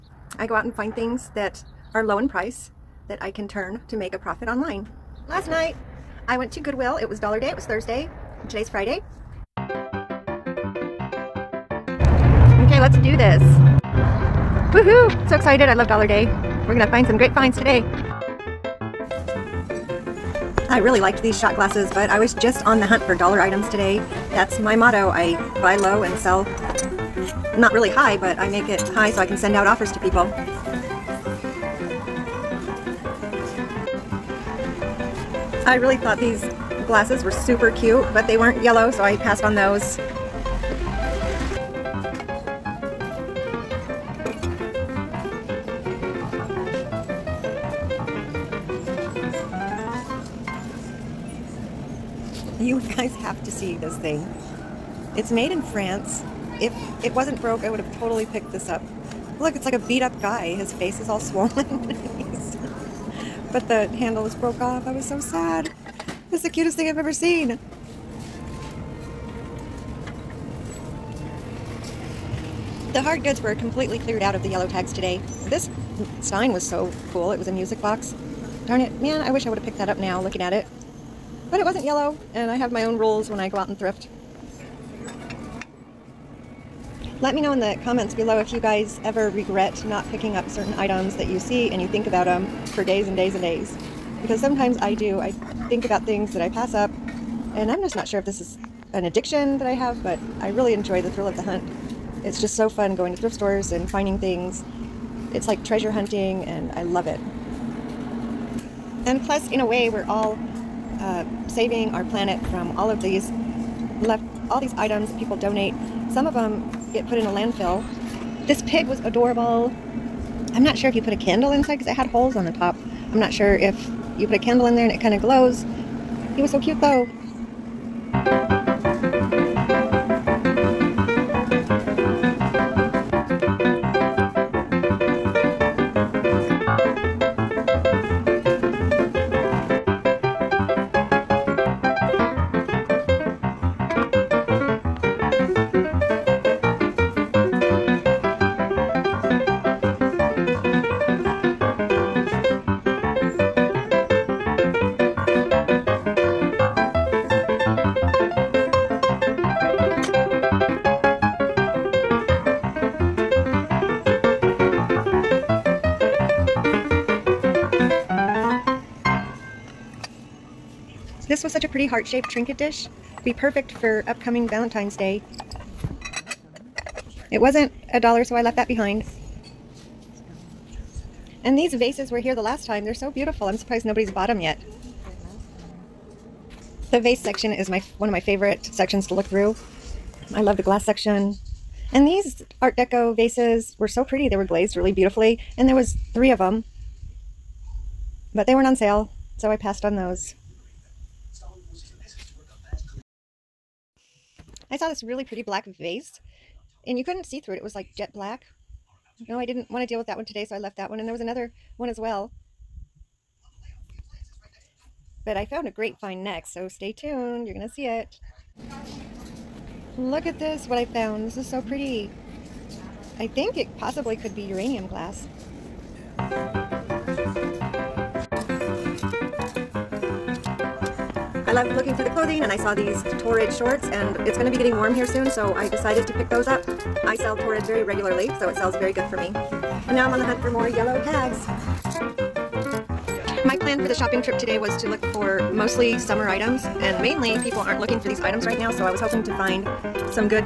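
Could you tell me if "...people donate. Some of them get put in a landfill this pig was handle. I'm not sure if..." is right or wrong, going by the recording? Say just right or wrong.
wrong.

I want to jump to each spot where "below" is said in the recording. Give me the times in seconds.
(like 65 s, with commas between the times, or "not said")
88 s.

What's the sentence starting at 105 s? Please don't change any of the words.
It's like treasure hunting, and I love it.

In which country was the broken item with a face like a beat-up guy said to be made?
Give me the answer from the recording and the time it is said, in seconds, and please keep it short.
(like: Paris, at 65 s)
France, at 55 s.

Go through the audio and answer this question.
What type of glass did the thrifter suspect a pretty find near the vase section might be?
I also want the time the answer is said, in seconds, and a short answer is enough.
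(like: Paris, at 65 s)
uranium glass, at 224 s.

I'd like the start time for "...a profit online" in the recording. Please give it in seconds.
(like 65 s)
4 s.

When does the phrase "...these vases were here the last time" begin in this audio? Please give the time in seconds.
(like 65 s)
181 s.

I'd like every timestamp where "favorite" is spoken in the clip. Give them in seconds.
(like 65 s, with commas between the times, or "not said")
188 s.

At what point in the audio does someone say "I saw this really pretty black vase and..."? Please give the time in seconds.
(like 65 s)
204 s.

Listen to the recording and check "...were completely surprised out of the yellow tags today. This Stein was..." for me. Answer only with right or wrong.
wrong.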